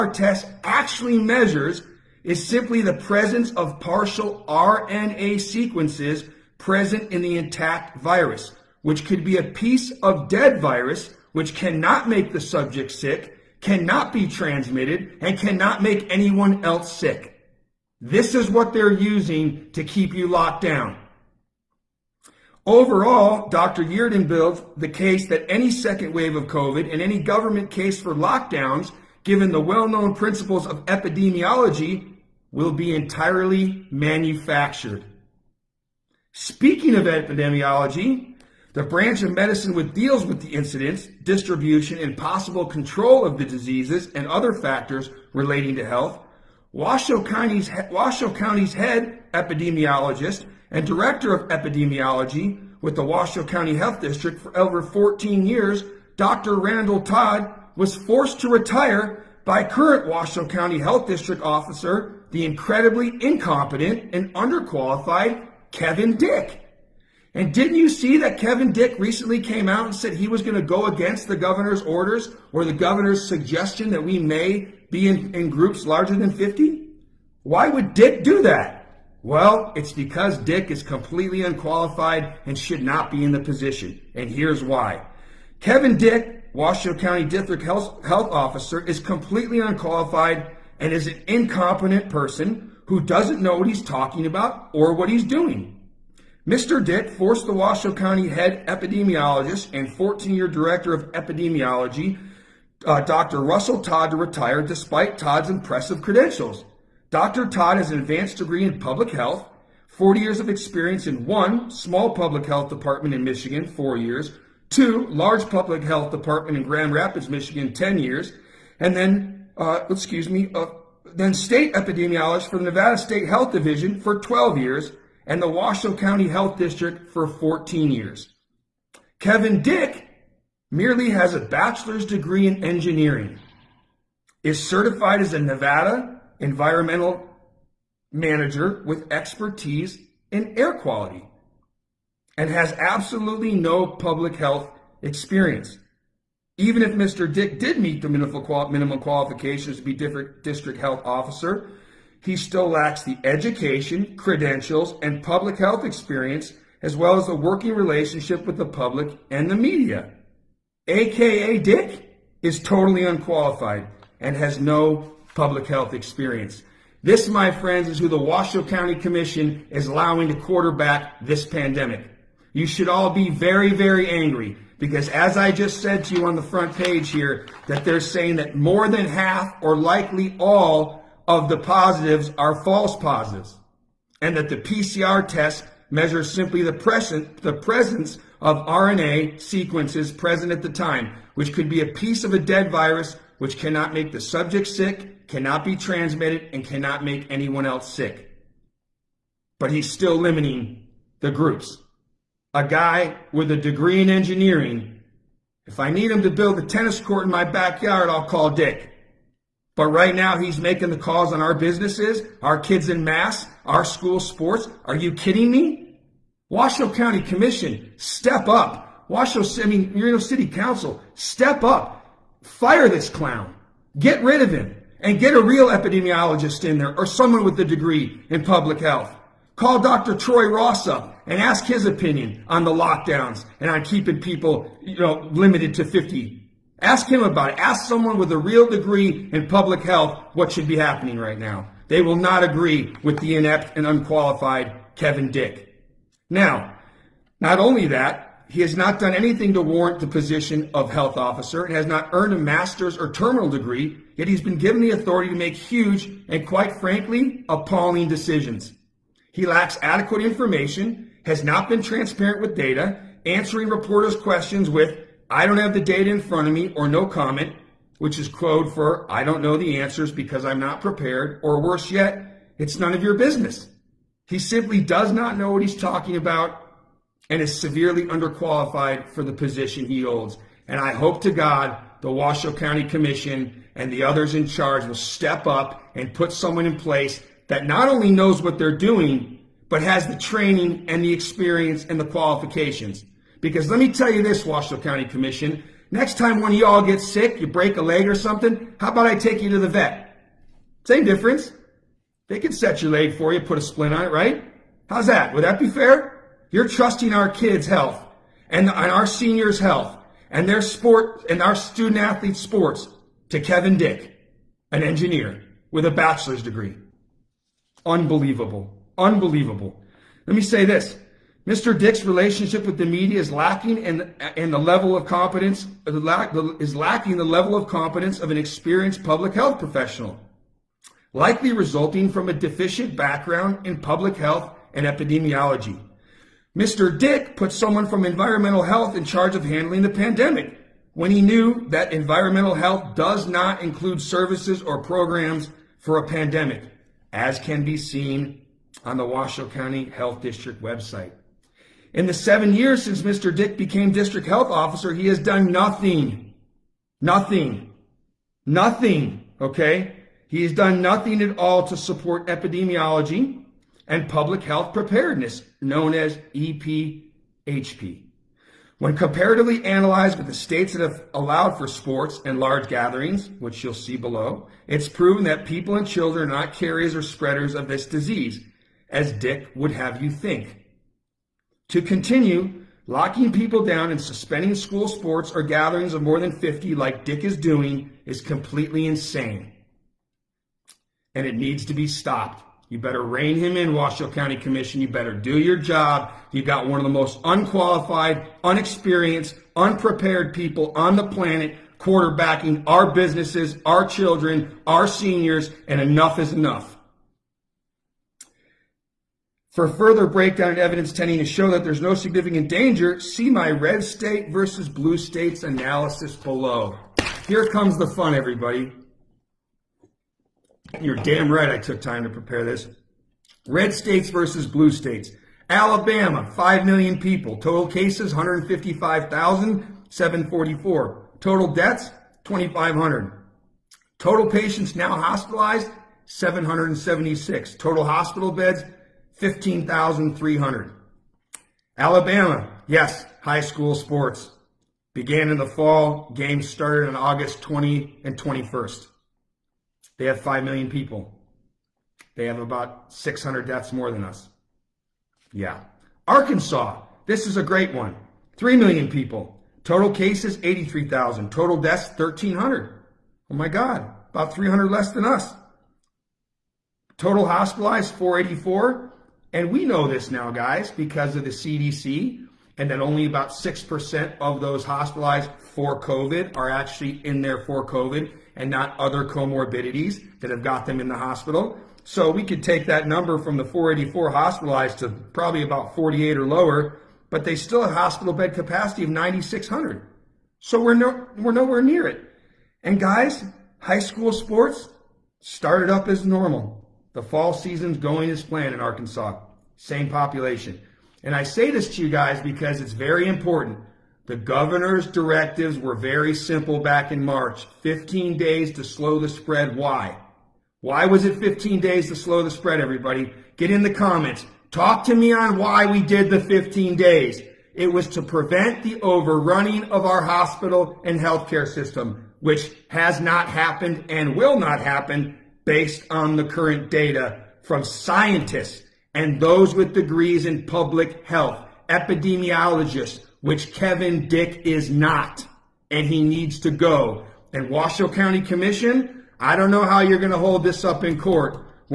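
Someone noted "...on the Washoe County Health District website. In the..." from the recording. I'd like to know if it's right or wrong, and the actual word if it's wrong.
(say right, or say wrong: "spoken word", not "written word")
right.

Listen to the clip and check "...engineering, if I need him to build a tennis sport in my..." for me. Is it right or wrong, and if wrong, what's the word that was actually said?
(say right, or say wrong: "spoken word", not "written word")
wrong: "court", not "sport".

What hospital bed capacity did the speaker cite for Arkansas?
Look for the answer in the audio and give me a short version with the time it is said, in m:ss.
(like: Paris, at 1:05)
9,600, at 8:08.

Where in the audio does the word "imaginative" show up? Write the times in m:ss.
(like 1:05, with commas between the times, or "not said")
not said.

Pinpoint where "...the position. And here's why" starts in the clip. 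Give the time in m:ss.
1:23.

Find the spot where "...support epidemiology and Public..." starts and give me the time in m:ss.
6:01.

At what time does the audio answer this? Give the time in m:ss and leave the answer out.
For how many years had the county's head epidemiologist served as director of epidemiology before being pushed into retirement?
0:54.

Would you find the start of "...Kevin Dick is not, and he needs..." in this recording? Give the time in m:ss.
8:53.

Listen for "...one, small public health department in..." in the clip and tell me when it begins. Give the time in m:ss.
1:51.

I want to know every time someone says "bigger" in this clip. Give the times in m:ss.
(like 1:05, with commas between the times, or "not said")
not said.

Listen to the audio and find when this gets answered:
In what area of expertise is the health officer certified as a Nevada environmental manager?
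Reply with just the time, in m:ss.
2:20.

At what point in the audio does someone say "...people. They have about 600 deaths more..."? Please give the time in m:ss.
7:30.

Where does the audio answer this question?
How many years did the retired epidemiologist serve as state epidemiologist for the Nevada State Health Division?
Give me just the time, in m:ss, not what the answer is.
2:04.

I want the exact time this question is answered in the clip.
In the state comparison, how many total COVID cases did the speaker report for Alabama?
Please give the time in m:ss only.
7:08.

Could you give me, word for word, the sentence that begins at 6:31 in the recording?
And it needs to be stopped.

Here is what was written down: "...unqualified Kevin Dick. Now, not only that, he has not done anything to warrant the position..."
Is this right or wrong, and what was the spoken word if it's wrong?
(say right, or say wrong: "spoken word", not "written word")
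right.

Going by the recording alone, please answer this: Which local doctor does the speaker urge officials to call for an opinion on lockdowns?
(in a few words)
Dr. Troy Ross.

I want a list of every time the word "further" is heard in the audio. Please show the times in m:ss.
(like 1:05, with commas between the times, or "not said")
6:49.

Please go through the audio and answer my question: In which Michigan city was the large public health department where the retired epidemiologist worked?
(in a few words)
Grand Rapids.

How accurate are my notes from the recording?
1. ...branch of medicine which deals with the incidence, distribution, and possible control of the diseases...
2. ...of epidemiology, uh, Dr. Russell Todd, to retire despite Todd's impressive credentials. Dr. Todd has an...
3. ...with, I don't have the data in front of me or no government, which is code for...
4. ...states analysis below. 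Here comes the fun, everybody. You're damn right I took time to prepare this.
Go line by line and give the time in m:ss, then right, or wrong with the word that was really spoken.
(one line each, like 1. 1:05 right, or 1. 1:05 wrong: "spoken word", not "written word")
1. 0:38 right
2. 1:40 right
3. 4:24 wrong: "comment", not "government"
4. 6:54 right.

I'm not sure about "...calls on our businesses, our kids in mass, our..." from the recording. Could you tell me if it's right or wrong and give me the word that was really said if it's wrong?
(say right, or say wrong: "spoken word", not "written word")
right.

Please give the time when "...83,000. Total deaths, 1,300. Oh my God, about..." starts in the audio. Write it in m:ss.
7:40.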